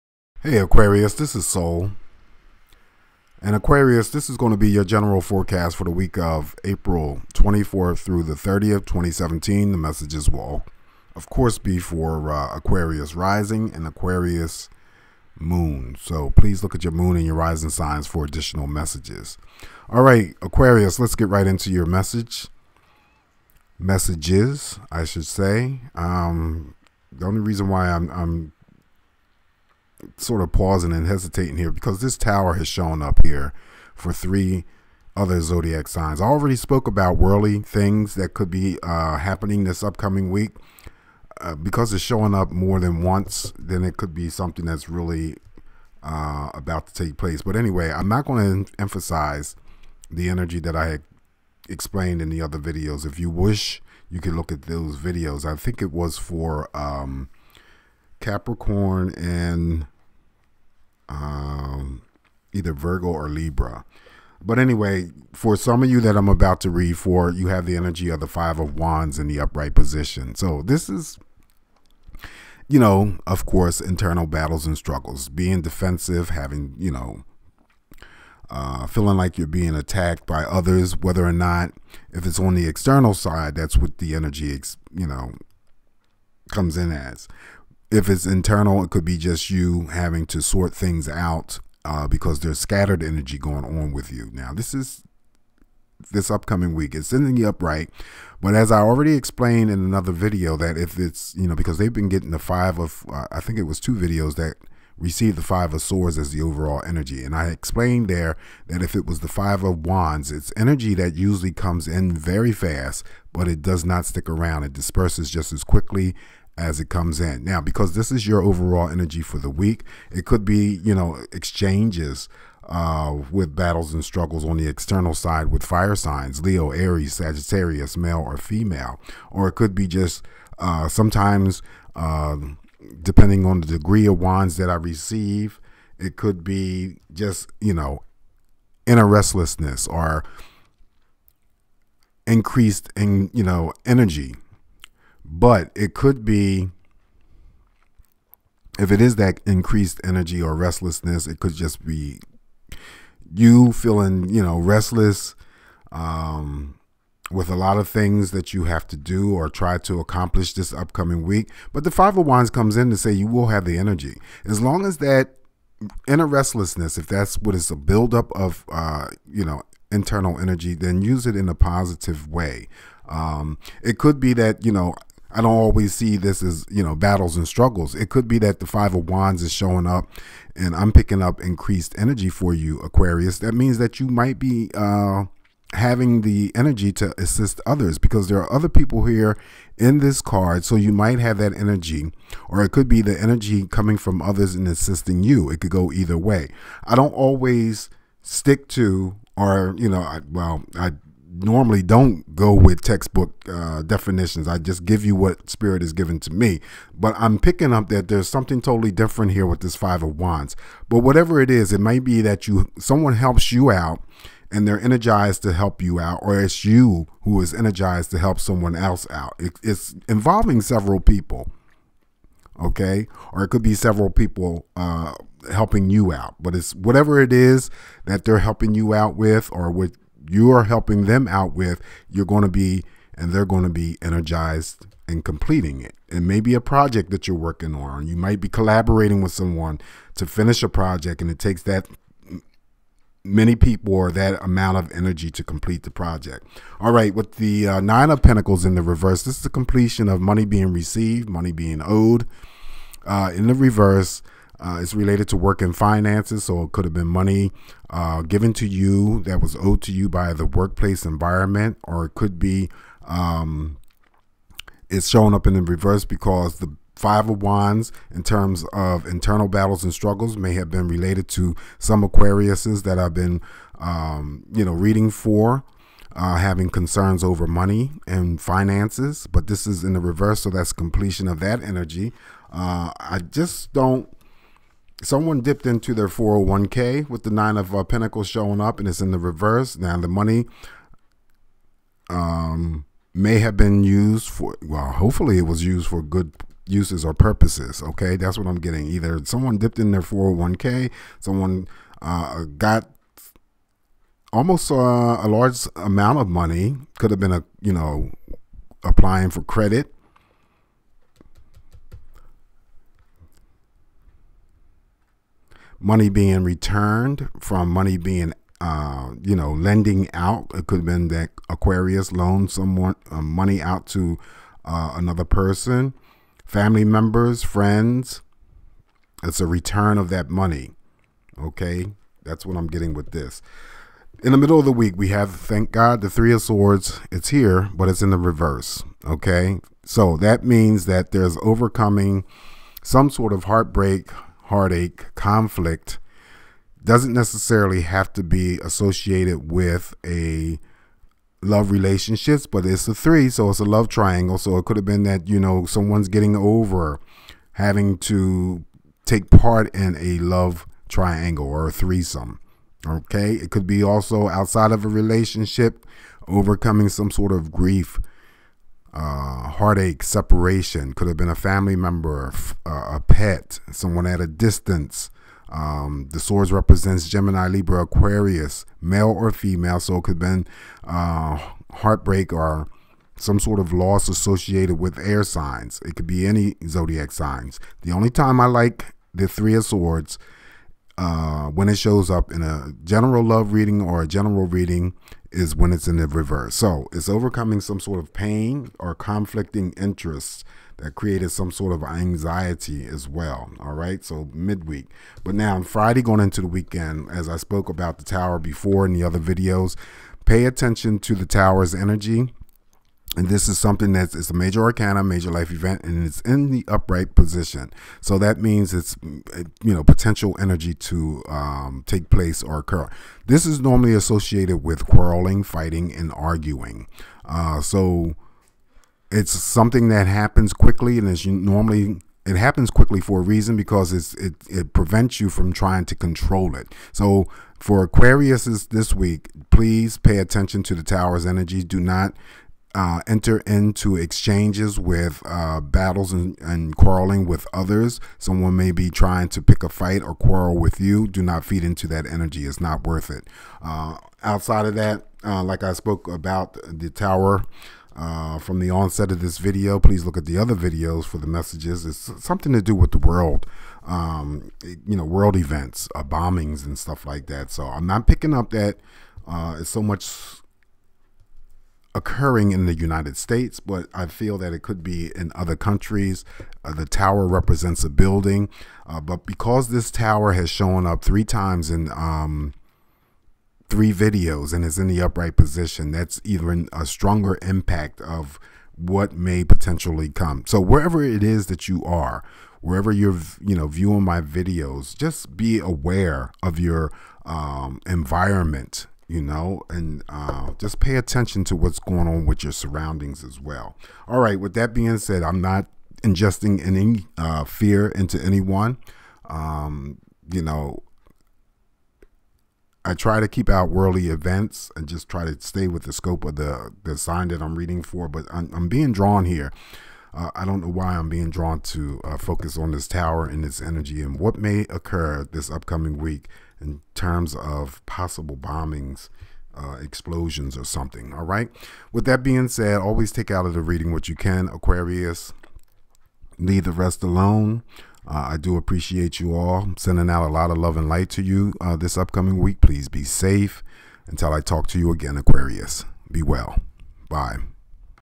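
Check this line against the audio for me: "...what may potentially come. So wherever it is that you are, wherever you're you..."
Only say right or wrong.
right.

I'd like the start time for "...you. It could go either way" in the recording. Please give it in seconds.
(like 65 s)
195 s.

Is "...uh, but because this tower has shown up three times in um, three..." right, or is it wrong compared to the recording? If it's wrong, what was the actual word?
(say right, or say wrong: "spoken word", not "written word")
right.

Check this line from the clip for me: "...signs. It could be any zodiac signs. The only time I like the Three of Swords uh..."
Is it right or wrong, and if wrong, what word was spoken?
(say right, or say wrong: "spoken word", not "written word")
right.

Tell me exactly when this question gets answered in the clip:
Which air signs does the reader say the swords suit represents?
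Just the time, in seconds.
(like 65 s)
377 s.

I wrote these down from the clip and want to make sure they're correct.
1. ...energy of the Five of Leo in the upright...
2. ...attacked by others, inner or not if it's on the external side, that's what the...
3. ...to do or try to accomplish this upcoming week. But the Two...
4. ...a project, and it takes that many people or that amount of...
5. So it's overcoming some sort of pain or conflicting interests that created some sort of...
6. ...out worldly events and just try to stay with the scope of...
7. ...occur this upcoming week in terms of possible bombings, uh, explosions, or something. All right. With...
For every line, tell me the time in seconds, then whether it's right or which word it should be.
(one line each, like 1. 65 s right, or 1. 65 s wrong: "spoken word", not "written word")
1. 67 s wrong: "Wands", not "Leo"
2. 79 s wrong: "whether", not "inner"
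3. 158 s wrong: "Five", not "Two"
4. 240 s right
5. 396 s right
6. 513 s right
7. 524 s right.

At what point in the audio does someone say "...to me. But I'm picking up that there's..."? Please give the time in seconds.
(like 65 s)
206 s.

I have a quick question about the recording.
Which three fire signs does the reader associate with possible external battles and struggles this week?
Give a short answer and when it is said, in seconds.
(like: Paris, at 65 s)
Leo, Aries, Sagittarius, at 126 s.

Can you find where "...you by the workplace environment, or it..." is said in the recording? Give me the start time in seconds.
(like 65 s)
259 s.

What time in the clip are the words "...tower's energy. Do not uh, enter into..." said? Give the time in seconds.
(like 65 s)
440 s.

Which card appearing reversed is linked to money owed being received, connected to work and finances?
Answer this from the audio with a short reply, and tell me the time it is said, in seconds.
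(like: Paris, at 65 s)
Nine of Pentacles, at 247 s.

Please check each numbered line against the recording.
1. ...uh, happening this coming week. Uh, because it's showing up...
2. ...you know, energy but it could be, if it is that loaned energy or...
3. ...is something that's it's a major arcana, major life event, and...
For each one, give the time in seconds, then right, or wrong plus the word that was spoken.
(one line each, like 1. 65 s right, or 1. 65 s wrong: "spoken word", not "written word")
1. 38 s wrong: "upcoming", not "coming"
2. 143 s wrong: "increased", not "loaned"
3. 413 s right.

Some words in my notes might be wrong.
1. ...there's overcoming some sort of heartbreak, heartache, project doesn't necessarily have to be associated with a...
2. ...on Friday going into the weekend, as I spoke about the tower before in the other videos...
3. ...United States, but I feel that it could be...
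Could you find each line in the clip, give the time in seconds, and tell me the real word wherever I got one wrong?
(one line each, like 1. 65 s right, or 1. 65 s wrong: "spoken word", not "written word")
1. 341 s wrong: "conflict", not "project"
2. 405 s right
3. 472 s right.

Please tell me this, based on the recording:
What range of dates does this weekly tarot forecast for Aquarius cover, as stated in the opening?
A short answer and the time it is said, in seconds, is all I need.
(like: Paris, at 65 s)
April 24th through the 30th, 2017, at 6 s.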